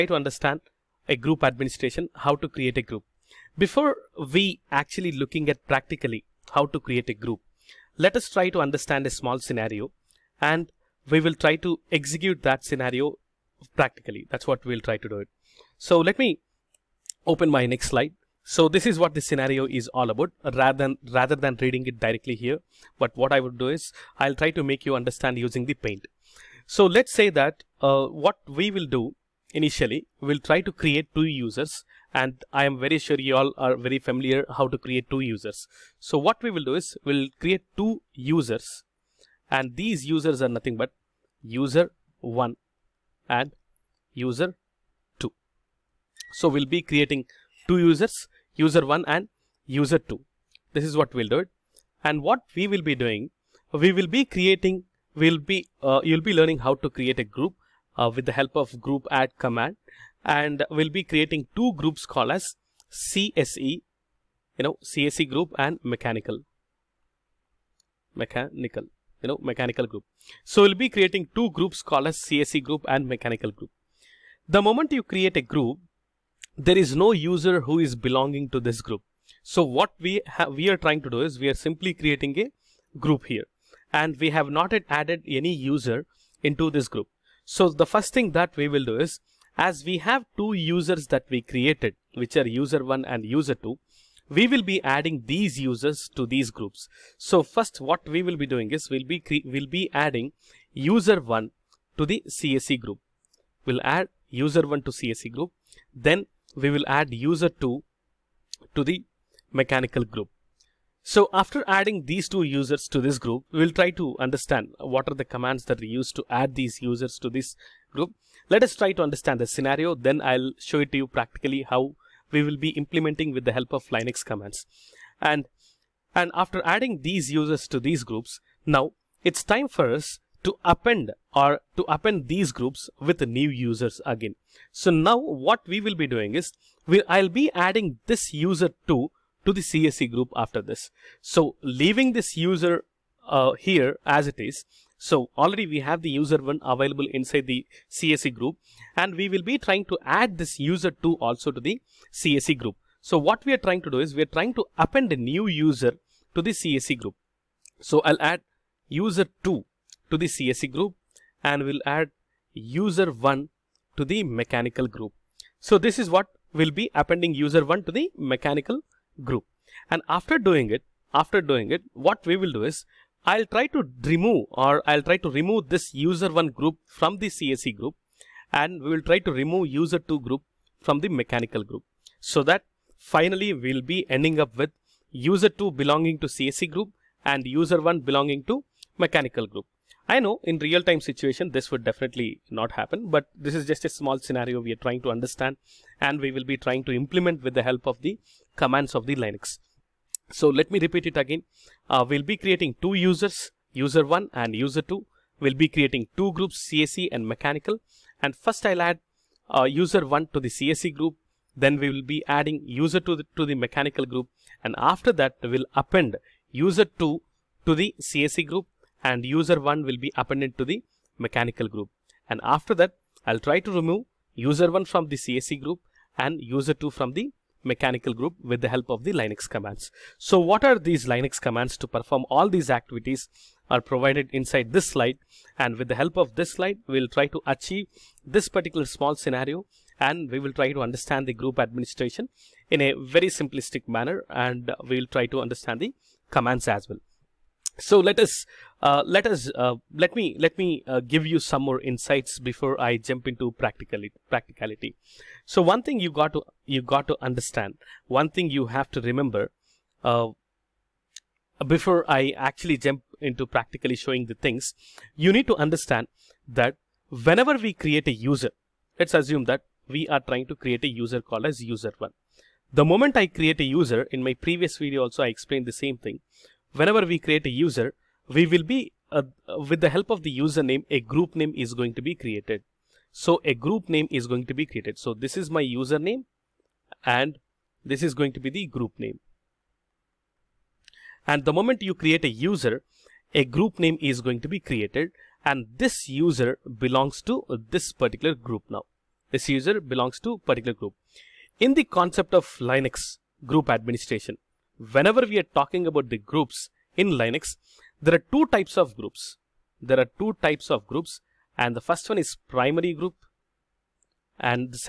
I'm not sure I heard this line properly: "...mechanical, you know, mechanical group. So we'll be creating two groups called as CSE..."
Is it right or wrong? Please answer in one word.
right.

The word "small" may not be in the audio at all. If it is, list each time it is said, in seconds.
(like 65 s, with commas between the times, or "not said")
9 s, 193 s, 238 s.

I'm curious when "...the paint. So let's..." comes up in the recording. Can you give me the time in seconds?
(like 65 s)
25 s.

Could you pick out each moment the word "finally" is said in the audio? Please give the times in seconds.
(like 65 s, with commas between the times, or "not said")
182 s.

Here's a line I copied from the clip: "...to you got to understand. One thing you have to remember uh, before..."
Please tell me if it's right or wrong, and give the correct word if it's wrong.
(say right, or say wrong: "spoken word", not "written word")
right.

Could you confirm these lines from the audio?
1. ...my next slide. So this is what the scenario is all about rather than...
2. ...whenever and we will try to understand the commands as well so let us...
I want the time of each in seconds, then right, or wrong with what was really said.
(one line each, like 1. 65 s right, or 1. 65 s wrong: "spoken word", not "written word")
1. 17 s right
2. 243 s wrong: "manner", not "whenever".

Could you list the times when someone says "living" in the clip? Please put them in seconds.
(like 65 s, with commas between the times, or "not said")
not said.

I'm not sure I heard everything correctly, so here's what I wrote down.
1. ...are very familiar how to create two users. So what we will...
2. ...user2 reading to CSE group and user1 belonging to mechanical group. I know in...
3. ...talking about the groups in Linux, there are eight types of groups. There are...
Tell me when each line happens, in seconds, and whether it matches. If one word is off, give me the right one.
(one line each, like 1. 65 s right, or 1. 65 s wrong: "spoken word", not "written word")
1. 33 s right
2. 185 s wrong: "belonging", not "reading"
3. 305 s wrong: "two", not "eight".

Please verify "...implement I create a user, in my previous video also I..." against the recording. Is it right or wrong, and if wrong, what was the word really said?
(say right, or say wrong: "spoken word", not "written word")
wrong: "moment", not "implement".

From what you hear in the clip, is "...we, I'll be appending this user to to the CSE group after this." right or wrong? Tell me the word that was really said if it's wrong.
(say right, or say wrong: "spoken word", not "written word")
wrong: "adding", not "appending".